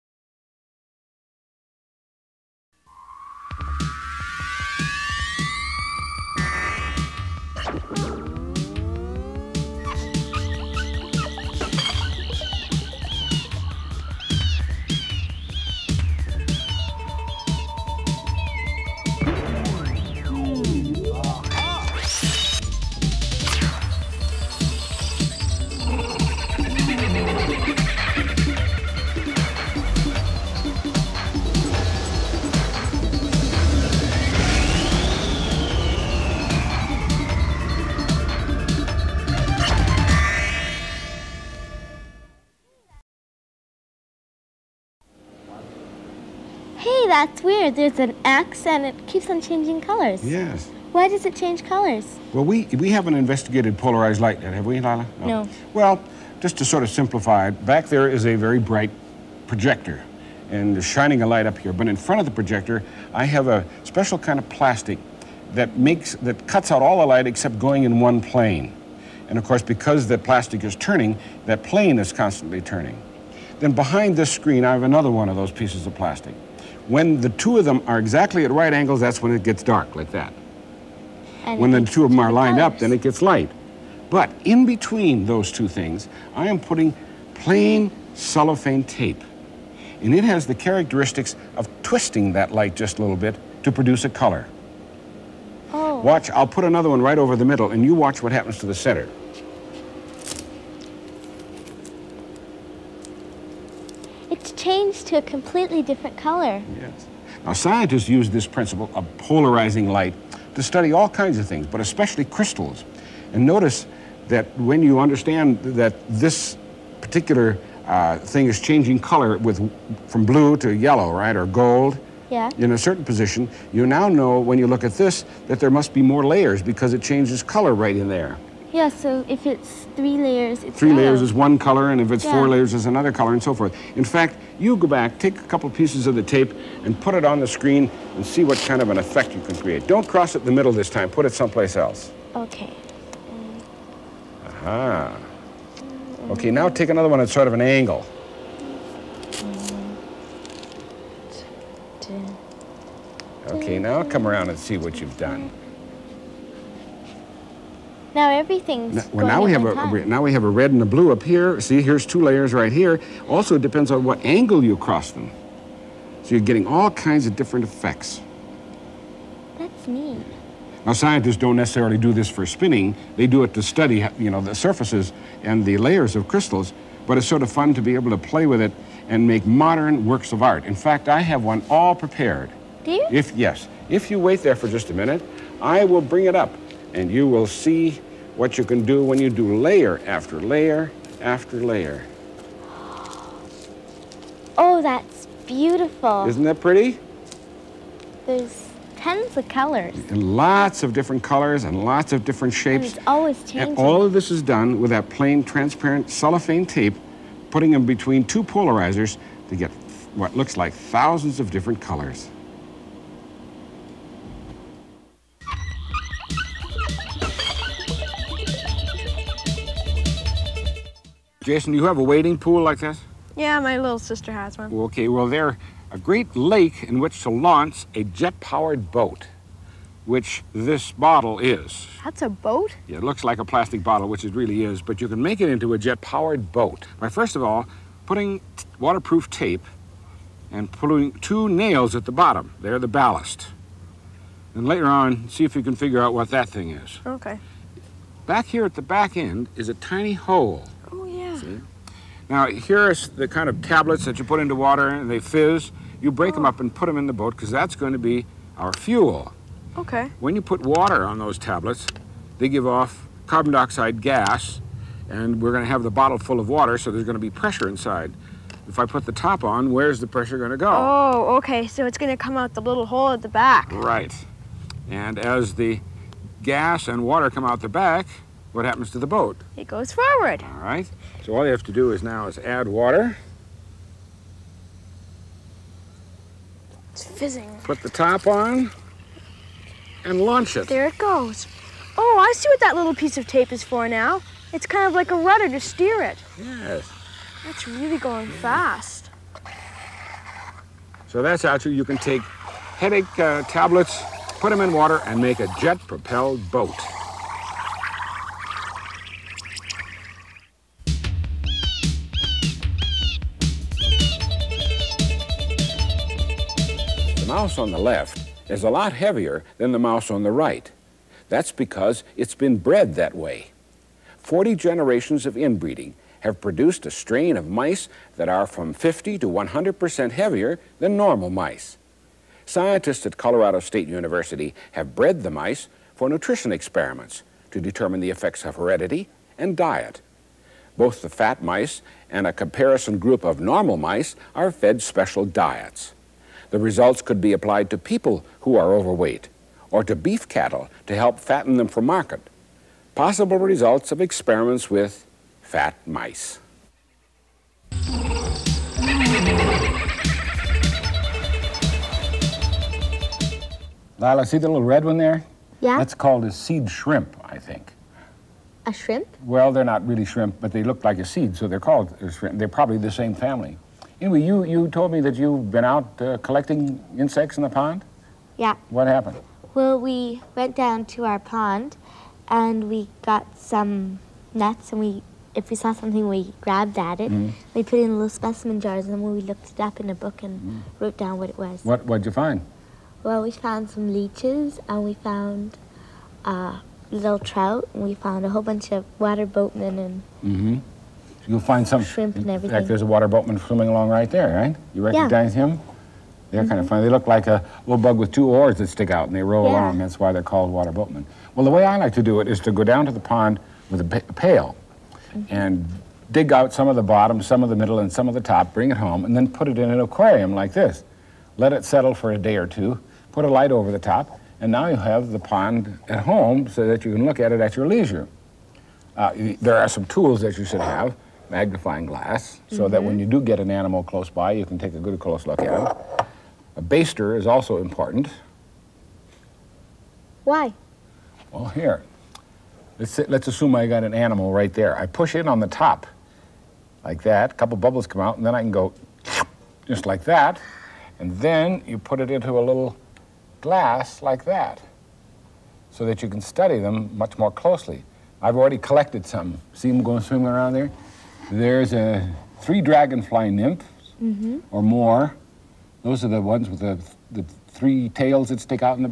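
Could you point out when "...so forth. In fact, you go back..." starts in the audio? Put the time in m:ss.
2:13.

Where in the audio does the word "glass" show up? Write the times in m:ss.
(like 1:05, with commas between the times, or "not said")
7:11, 7:33.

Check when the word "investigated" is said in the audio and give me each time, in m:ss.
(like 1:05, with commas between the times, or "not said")
0:53.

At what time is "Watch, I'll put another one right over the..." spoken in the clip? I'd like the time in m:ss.
1:36.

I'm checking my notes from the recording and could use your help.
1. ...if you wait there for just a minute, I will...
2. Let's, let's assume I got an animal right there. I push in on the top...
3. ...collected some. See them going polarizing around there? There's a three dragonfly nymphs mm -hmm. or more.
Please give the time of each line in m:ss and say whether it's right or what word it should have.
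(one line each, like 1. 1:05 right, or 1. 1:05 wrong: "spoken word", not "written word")
1. 3:03 right
2. 7:22 right
3. 7:38 wrong: "swimming", not "polarizing".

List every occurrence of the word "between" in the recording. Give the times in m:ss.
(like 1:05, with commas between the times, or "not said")
1:24, 3:27.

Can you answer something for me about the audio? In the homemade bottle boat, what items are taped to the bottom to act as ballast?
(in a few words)
two nails.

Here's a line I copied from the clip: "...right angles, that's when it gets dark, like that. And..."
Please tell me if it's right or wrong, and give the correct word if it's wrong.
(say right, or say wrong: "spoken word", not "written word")
right.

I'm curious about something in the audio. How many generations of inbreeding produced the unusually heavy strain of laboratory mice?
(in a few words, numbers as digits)
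40.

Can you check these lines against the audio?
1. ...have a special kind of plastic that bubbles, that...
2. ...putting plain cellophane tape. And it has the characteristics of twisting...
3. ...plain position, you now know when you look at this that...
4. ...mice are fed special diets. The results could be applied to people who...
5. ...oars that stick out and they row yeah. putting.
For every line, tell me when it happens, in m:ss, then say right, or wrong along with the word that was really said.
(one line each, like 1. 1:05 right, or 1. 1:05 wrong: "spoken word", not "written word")
1. 1:03 wrong: "makes", not "bubbles"
2. 1:26 right
3. 2:02 wrong: "certain", not "plain"
4. 5:43 right
5. 6:48 wrong: "along", not "putting".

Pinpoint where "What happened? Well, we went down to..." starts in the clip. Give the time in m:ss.
6:18.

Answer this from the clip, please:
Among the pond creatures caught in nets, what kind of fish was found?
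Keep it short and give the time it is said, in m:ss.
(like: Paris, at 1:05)
trout, at 6:37.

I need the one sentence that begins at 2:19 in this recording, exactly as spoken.
Don't cross it the middle this time.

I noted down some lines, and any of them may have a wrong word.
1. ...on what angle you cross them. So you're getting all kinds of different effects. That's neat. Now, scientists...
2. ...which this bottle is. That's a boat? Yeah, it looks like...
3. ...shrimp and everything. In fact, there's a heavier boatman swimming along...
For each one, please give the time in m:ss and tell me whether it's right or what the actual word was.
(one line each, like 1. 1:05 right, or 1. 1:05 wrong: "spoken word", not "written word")
1. 2:43 right
2. 3:50 right
3. 6:41 wrong: "water", not "heavier".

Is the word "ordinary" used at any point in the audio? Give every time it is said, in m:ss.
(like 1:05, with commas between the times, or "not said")
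not said.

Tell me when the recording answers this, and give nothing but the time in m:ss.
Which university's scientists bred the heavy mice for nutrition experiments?
5:33.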